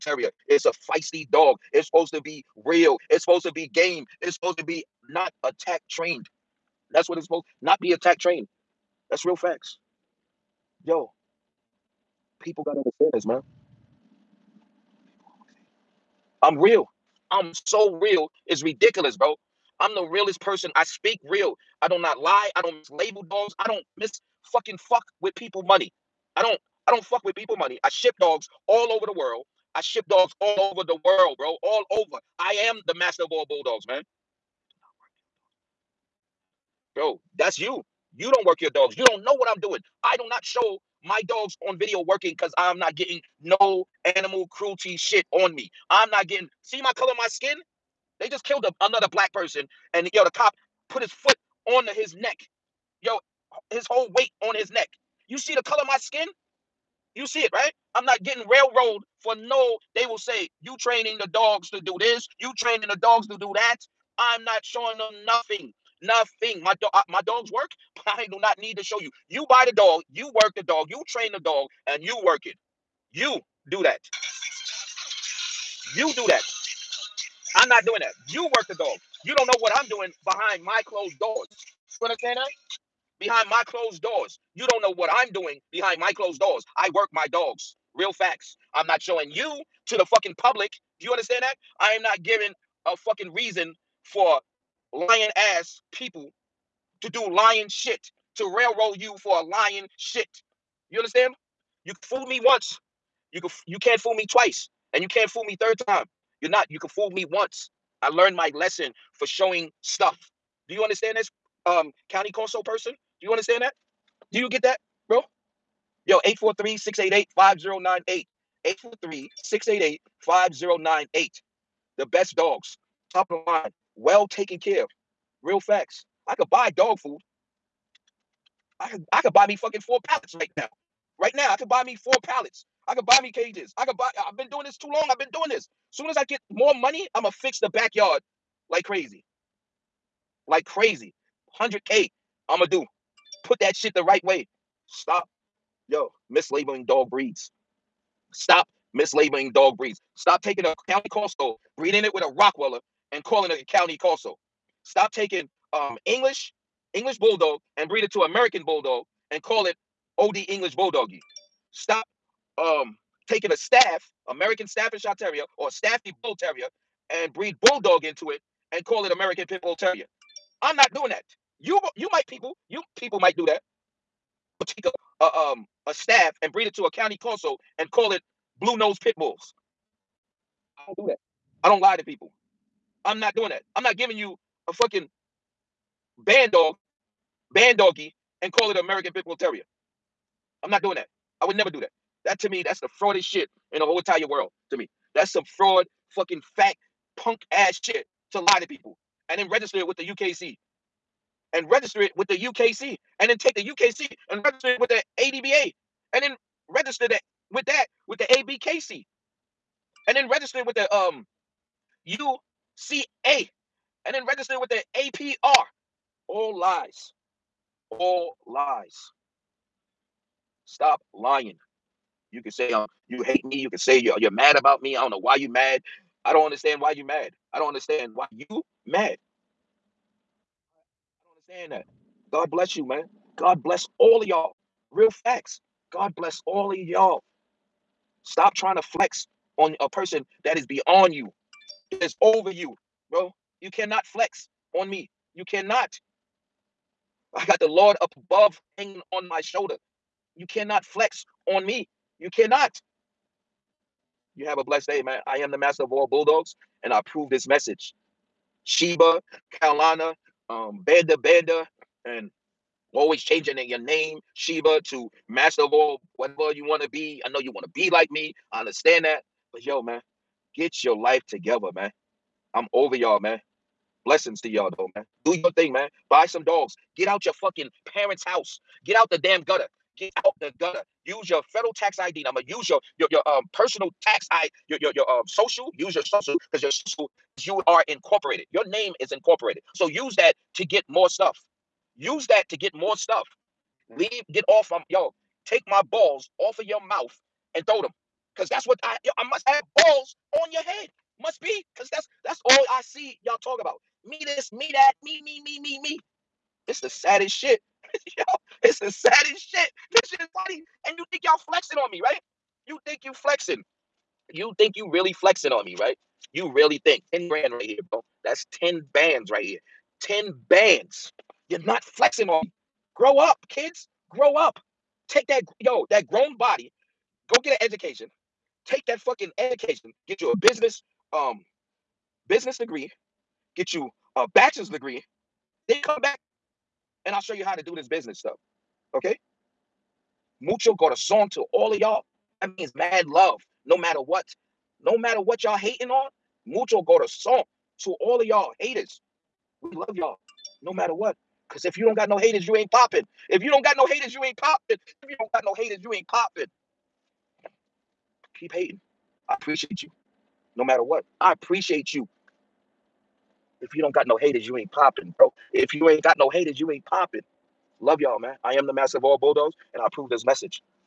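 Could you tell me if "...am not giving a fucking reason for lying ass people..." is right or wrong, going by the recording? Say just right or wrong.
right.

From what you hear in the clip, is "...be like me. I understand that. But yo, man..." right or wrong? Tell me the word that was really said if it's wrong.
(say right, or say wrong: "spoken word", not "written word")
right.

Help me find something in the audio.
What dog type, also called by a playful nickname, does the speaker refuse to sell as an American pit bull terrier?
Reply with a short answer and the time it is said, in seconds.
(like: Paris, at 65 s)
bandog, at 186 s.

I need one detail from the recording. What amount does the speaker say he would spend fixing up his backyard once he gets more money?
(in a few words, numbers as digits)
100K.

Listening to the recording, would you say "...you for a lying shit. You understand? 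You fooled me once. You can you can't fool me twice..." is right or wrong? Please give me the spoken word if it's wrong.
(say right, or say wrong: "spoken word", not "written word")
right.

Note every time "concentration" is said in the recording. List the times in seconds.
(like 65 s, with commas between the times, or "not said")
not said.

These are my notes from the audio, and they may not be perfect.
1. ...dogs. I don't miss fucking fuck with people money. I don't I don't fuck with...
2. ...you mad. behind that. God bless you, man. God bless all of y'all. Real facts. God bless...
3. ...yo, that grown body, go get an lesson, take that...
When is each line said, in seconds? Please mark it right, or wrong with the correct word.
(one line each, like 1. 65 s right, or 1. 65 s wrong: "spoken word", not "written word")
1. 23 s right
2. 228 s wrong: "understand", not "behind"
3. 325 s wrong: "education", not "lesson".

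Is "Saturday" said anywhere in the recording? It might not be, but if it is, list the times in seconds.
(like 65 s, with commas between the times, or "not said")
not said.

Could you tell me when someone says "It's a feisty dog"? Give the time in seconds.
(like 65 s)
0 s.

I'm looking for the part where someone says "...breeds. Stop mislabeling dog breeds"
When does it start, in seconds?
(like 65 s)
147 s.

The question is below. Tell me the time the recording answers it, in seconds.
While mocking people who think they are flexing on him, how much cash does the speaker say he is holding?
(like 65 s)
317 s.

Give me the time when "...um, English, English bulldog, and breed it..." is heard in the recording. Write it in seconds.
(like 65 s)
155 s.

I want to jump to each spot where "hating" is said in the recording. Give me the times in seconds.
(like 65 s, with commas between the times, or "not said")
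345 s, 358 s.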